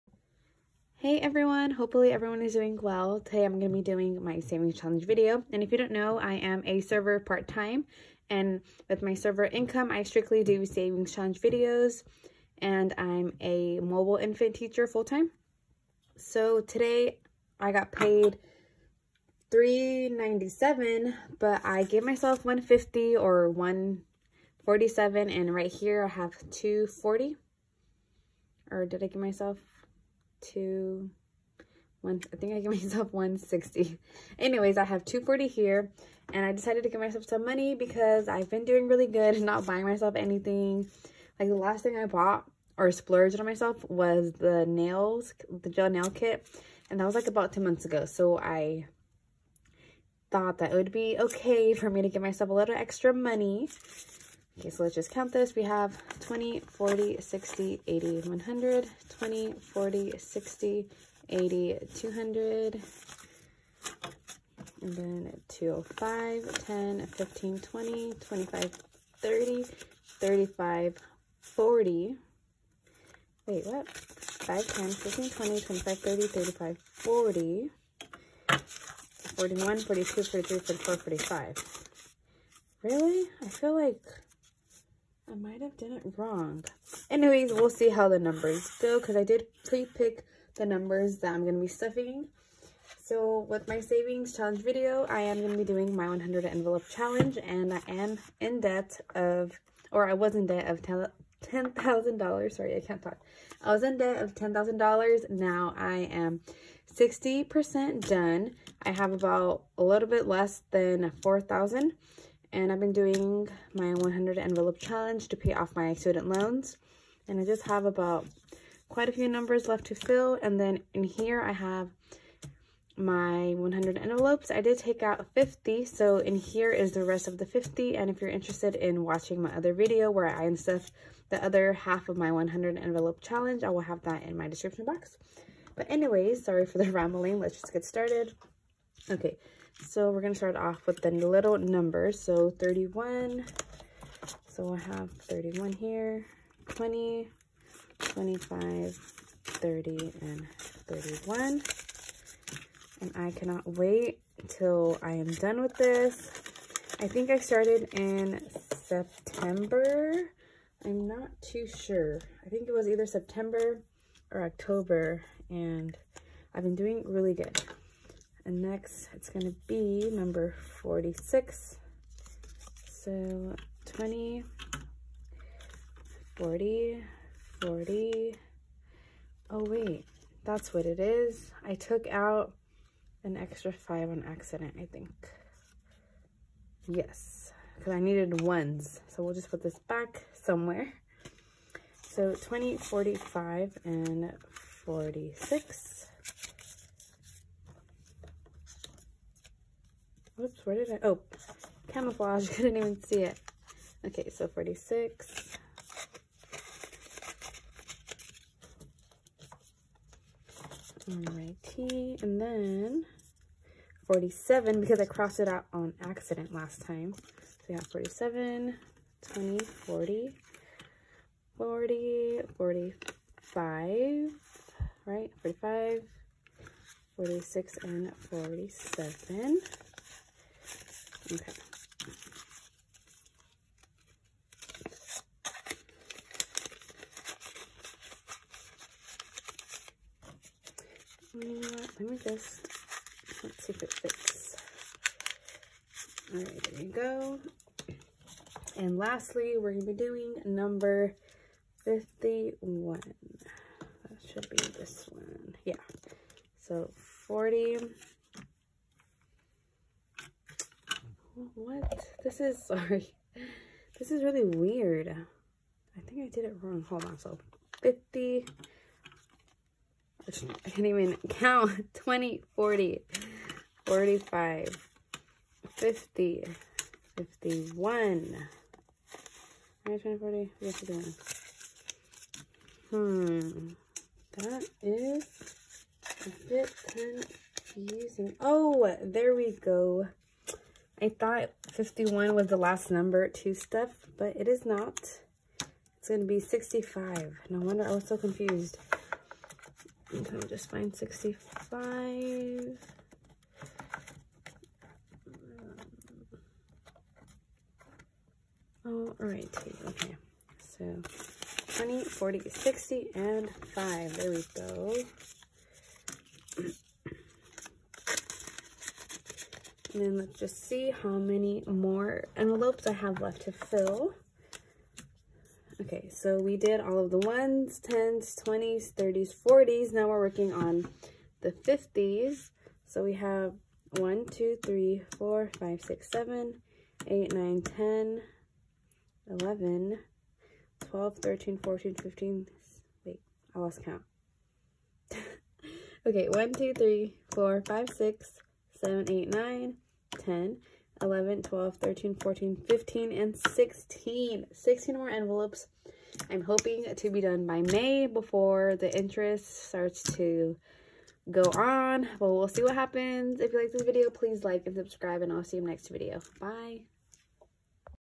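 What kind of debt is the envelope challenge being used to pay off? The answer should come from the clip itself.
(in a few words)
student loans.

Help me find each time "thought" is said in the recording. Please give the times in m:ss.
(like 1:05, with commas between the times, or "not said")
0:50, 4:51.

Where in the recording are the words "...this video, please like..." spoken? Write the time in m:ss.
6:03.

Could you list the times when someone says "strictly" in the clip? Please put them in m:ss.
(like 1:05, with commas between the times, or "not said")
0:10.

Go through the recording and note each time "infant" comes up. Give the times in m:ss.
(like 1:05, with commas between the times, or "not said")
0:14.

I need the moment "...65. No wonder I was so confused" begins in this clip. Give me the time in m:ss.
4:56.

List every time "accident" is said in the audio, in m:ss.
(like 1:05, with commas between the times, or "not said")
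3:04, 3:36.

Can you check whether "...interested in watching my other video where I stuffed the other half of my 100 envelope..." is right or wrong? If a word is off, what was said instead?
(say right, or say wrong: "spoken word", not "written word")
right.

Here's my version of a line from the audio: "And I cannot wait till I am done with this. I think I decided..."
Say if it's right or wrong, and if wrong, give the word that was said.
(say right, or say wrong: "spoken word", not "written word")
wrong: "started", not "decided".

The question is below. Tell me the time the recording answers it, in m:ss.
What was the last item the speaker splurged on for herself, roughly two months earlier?
0:45.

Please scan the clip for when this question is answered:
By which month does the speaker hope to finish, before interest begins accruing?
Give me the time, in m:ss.
5:57.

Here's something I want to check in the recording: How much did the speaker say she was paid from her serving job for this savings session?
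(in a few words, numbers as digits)
397.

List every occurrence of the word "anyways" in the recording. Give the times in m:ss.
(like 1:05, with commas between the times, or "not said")
0:34, 1:27, 2:15.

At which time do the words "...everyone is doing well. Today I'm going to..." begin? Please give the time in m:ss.
0:02.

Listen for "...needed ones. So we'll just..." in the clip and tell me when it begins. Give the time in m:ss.
3:07.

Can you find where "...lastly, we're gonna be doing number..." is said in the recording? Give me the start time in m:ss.
4:08.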